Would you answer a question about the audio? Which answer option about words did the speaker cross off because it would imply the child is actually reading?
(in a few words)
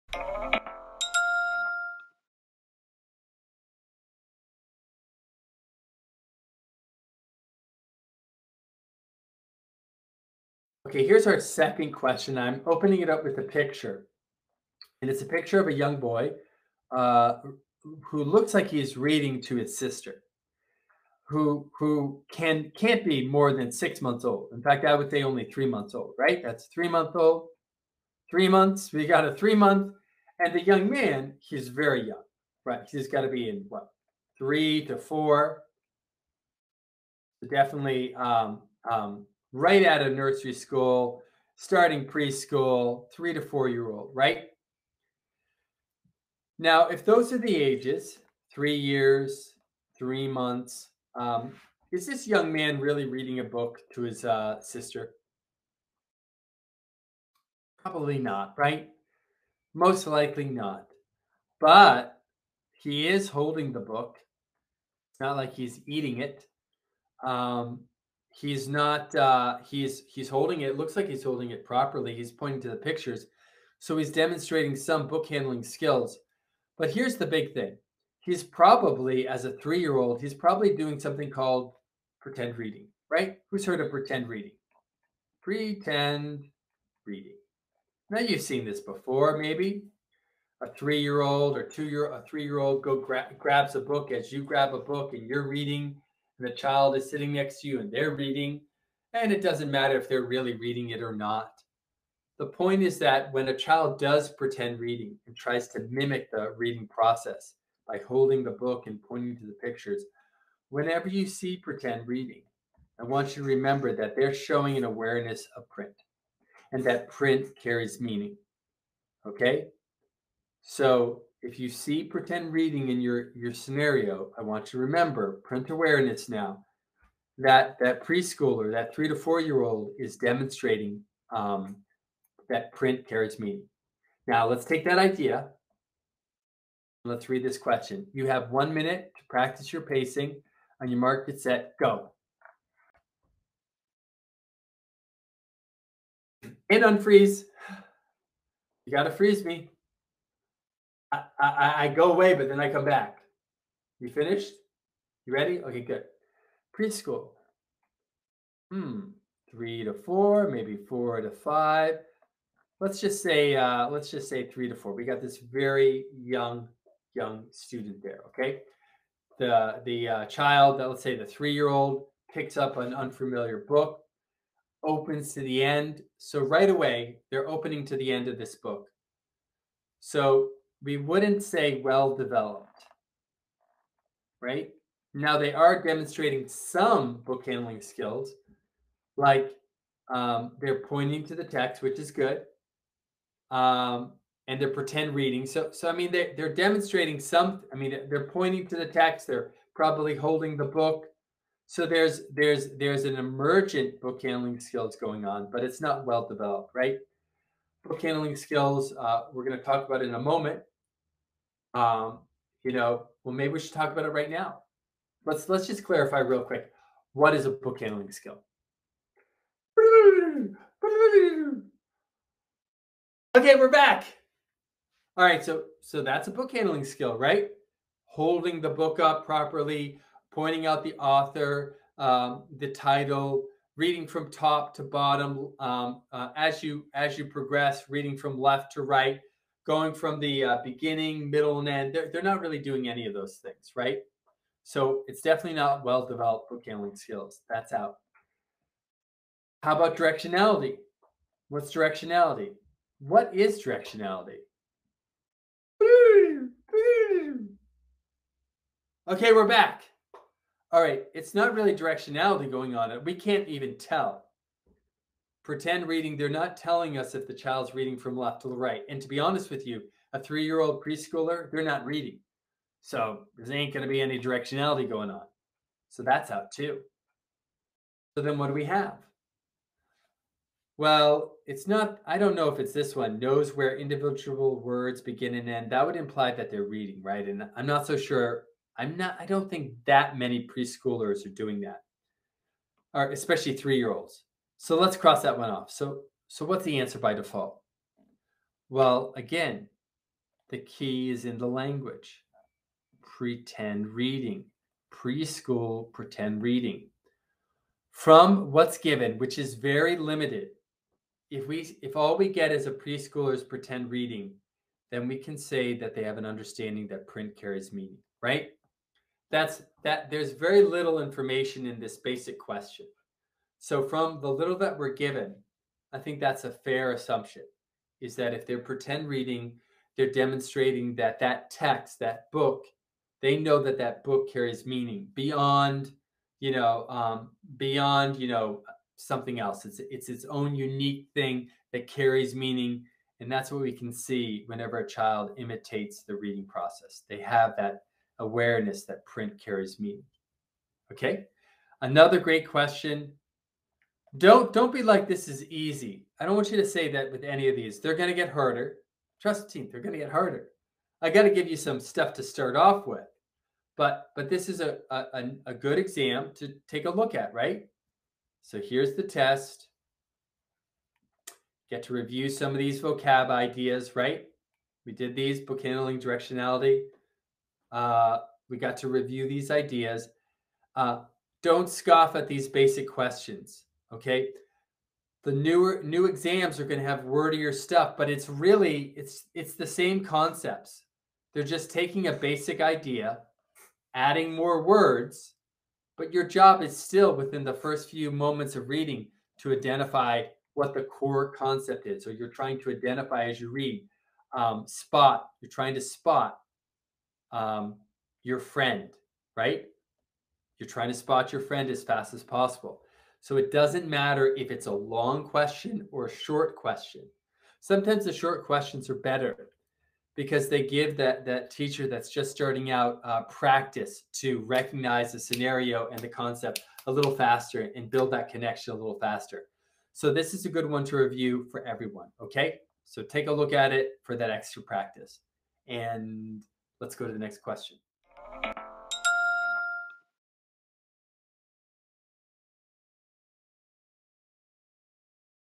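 knows where individual words begin and end.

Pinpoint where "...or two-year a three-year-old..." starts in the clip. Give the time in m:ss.
1:31.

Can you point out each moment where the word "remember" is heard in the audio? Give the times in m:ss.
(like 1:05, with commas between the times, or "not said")
1:53, 2:04.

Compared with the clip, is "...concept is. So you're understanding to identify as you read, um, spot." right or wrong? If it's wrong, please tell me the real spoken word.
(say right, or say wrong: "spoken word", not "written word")
wrong: "trying", not "understanding".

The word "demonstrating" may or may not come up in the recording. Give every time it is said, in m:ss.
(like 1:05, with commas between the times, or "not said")
1:14, 2:10, 3:05, 3:16, 5:30.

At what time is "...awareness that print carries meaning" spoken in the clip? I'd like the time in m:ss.
5:48.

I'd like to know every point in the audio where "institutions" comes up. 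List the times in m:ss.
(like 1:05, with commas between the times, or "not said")
not said.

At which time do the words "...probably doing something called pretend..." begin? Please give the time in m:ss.
1:20.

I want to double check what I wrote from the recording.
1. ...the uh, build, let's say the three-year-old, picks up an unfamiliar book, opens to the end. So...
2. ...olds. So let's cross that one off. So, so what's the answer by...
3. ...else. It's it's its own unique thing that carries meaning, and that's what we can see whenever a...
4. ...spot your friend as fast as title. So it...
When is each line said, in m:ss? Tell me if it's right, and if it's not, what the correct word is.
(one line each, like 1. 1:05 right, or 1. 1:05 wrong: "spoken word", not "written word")
1. 2:49 wrong: "child", not "build"
2. 4:53 right
3. 5:39 right
4. 6:50 wrong: "possible", not "title".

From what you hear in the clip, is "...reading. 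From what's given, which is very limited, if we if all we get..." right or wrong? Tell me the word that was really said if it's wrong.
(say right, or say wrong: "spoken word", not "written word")
right.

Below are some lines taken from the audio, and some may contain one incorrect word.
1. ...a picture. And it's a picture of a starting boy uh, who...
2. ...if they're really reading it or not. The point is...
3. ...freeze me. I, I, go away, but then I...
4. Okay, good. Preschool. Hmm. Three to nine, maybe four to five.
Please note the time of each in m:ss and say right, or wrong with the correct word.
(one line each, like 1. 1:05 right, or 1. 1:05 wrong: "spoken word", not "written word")
1. 0:13 wrong: "young", not "starting"
2. 1:39 right
3. 2:29 right
4. 2:35 wrong: "four", not "nine".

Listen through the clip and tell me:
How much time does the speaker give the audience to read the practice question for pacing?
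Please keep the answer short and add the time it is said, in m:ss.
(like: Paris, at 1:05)
one minute, at 2:18.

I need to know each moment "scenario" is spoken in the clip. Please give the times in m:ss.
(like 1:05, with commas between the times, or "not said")
2:03, 7:05.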